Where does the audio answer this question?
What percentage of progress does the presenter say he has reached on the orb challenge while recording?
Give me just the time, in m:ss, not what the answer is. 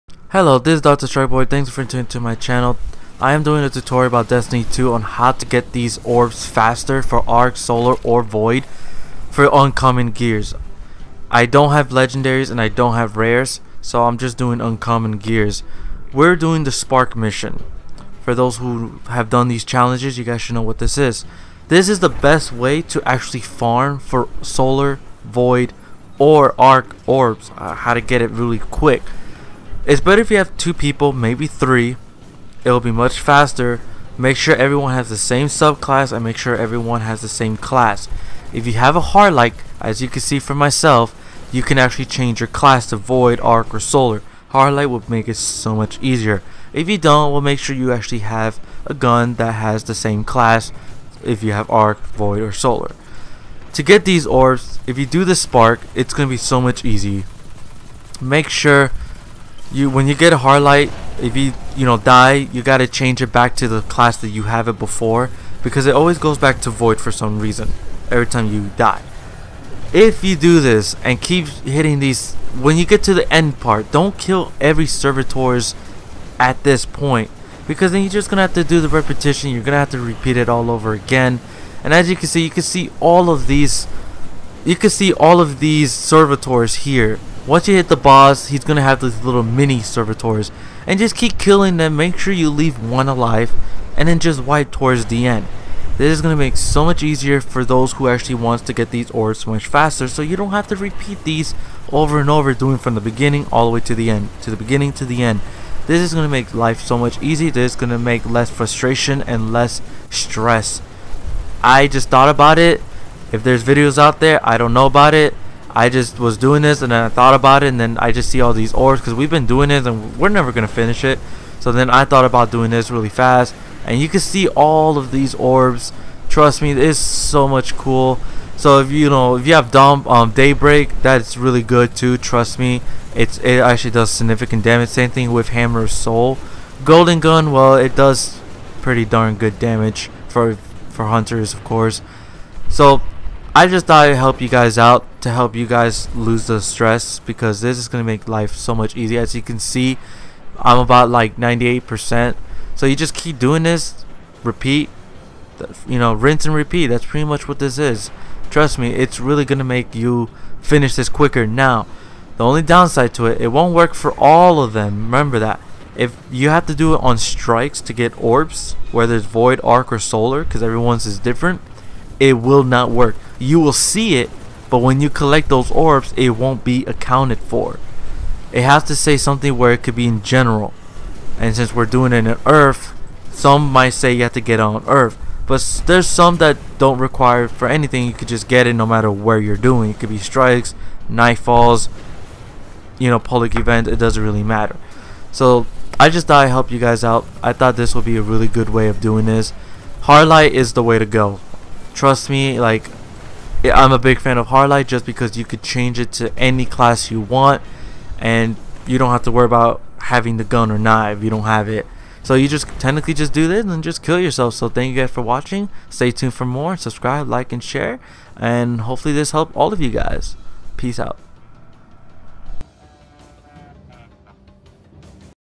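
2:31.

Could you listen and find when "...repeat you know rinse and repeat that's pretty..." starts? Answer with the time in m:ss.
2:34.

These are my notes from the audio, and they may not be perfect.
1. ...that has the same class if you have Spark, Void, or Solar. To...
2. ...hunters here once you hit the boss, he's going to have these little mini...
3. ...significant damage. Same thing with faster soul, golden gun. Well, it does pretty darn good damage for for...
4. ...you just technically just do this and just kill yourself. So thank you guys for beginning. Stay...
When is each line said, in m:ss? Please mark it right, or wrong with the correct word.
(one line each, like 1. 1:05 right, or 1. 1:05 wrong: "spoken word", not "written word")
1. 0:49 wrong: "Arc", not "Spark"
2. 1:25 wrong: "servitors", not "hunters"
3. 2:14 wrong: "hammer", not "faster"
4. 3:32 wrong: "watching", not "beginning".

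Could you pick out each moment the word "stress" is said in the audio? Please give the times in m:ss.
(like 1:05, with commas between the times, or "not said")
1:50, 2:26.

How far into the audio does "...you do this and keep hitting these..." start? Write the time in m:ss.
1:10.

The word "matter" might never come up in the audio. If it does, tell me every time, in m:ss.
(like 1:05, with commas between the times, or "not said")
3:08, 3:14.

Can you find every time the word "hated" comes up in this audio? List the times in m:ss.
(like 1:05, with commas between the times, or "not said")
not said.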